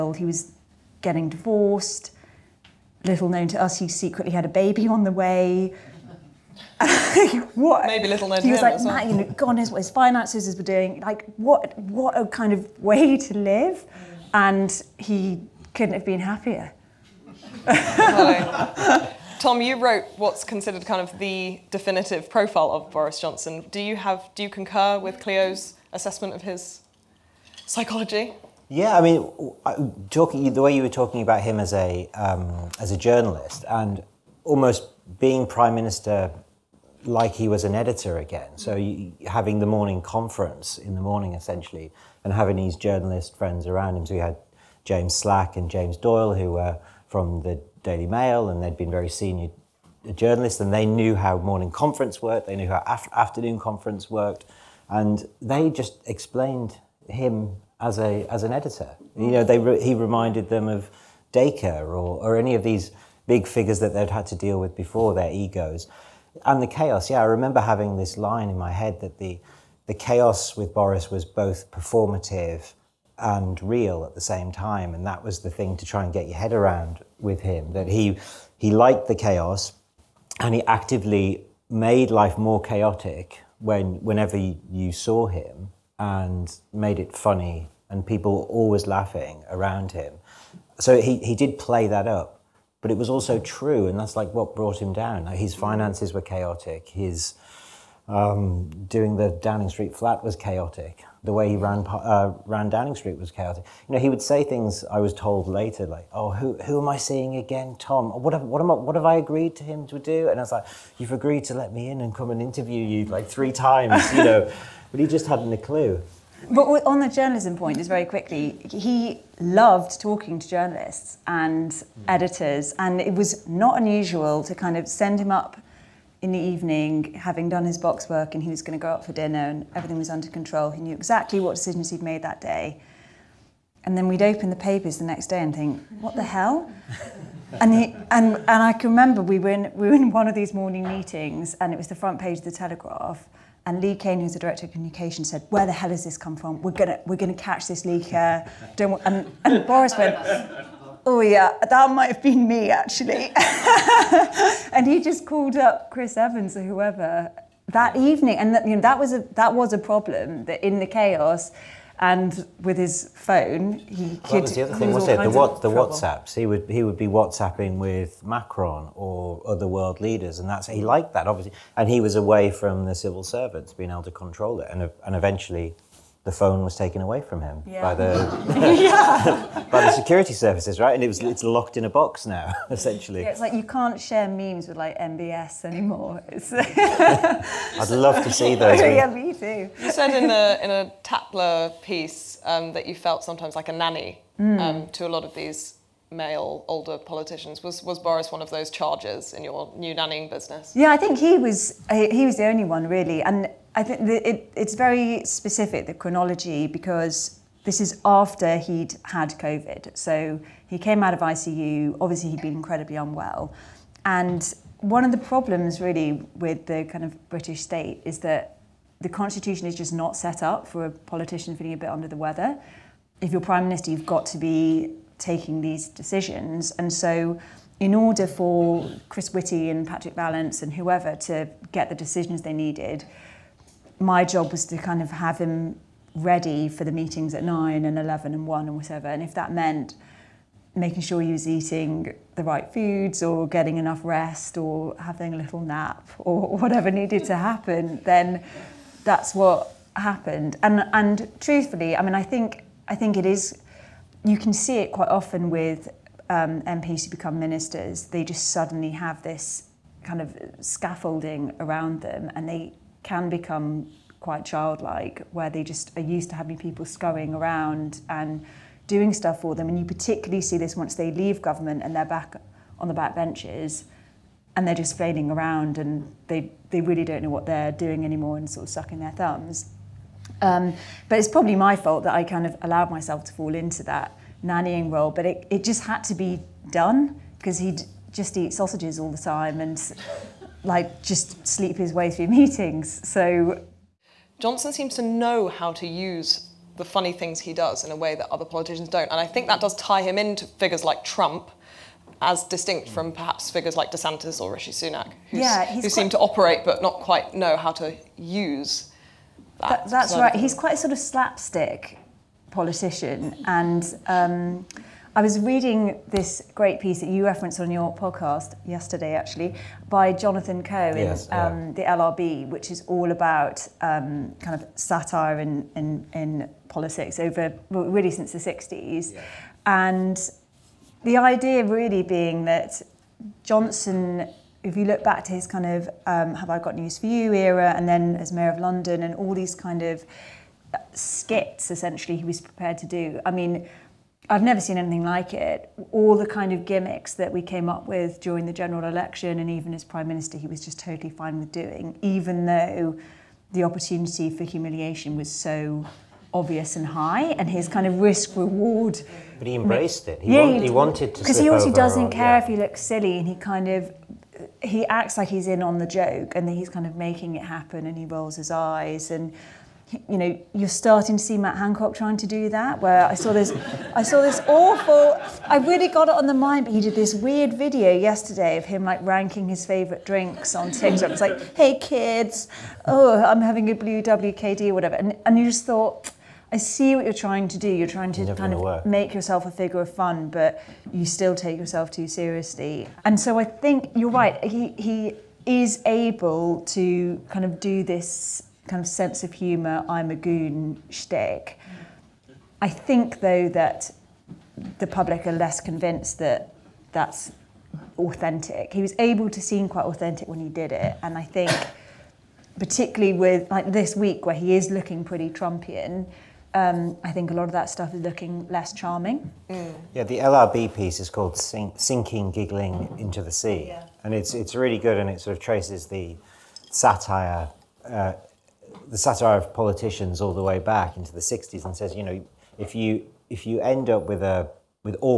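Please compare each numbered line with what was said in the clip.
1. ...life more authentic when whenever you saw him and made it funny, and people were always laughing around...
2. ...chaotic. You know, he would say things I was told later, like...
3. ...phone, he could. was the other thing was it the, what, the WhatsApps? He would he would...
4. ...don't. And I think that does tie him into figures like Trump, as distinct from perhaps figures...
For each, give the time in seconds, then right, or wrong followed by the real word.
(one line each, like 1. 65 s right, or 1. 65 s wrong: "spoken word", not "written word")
1. 82 s wrong: "chaotic", not "authentic"
2. 103 s right
3. 163 s right
4. 298 s right.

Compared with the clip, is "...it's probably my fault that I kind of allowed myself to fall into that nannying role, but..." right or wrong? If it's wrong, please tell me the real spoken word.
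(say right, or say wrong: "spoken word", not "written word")
right.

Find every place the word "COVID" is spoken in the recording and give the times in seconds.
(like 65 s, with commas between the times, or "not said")
209 s.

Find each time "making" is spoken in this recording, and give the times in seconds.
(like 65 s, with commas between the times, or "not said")
240 s, 366 s.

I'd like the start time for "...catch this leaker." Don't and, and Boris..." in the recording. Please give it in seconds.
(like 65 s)
147 s.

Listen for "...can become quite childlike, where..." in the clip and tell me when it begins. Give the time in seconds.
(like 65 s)
263 s.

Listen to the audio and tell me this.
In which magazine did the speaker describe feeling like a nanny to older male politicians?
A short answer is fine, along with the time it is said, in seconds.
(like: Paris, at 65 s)
Tatler, at 191 s.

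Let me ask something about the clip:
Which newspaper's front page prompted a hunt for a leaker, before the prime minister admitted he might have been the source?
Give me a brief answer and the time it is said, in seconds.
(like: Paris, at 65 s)
The Telegraph, at 142 s.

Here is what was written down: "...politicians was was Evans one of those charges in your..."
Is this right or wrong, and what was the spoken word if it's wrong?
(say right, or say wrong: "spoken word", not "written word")
wrong: "Boris", not "Evans".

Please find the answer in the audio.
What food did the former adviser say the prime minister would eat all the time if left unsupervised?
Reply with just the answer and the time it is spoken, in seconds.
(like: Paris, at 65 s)
Sausages, at 288 s.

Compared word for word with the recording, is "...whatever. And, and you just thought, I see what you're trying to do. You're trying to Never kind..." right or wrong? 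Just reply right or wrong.
right.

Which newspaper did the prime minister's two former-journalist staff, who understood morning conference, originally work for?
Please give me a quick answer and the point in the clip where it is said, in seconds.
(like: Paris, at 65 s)
Daily Mail, at 47 s.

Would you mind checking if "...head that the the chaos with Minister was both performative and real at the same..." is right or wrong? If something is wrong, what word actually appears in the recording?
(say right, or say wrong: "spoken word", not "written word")
wrong: "Boris", not "Minister".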